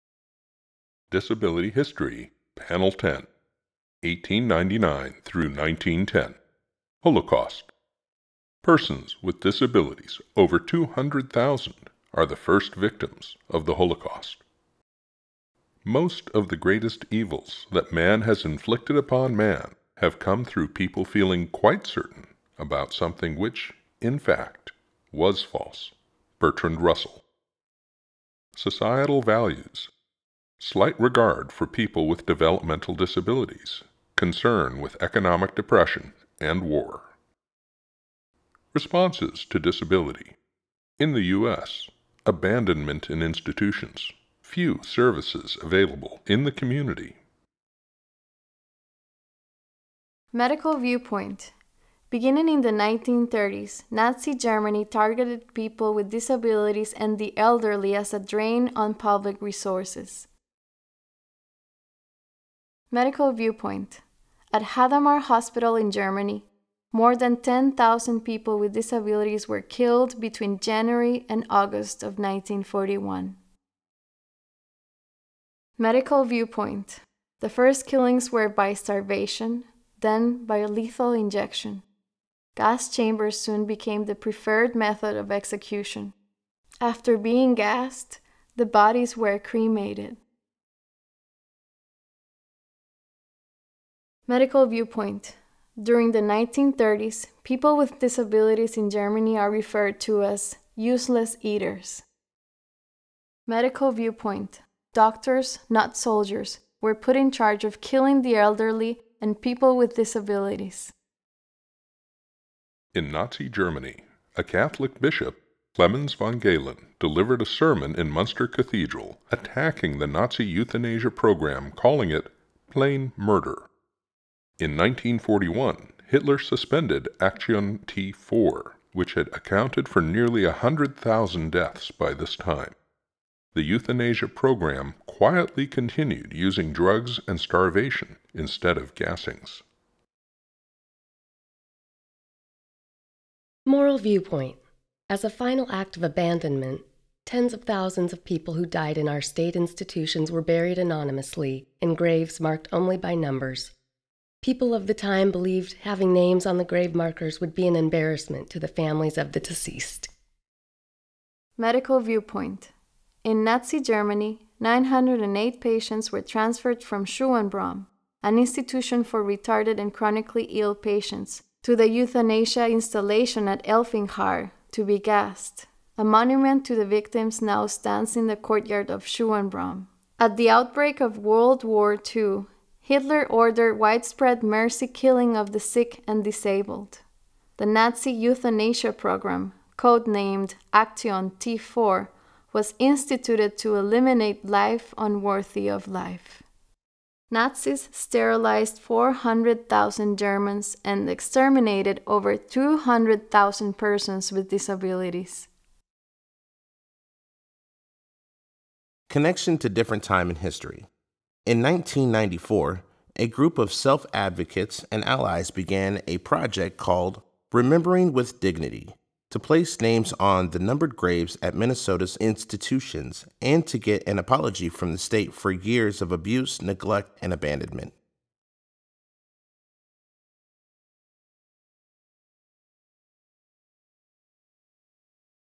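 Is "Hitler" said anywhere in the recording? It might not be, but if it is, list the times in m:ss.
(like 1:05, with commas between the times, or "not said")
2:06, 3:02.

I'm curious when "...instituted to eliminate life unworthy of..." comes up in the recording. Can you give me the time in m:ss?
3:12.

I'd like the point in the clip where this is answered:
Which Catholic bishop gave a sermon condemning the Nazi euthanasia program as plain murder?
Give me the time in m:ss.
1:55.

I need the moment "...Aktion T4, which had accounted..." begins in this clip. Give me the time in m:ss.
2:07.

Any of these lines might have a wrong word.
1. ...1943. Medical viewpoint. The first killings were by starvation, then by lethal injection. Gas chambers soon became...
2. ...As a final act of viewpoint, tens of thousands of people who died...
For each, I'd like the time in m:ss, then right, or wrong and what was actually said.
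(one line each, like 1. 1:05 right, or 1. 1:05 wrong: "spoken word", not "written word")
1. 1:12 wrong: "1941", not "1943"
2. 2:25 wrong: "abandonment", not "viewpoint".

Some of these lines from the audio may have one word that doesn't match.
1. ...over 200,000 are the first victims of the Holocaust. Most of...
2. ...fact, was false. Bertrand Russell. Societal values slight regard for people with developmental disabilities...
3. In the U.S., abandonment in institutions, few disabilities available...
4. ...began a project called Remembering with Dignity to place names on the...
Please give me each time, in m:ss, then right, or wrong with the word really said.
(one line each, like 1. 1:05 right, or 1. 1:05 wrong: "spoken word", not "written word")
1. 0:10 right
2. 0:24 right
3. 0:40 wrong: "services", not "disabilities"
4. 3:35 right.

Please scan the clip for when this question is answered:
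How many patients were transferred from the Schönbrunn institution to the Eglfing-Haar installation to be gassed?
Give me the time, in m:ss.
2:44.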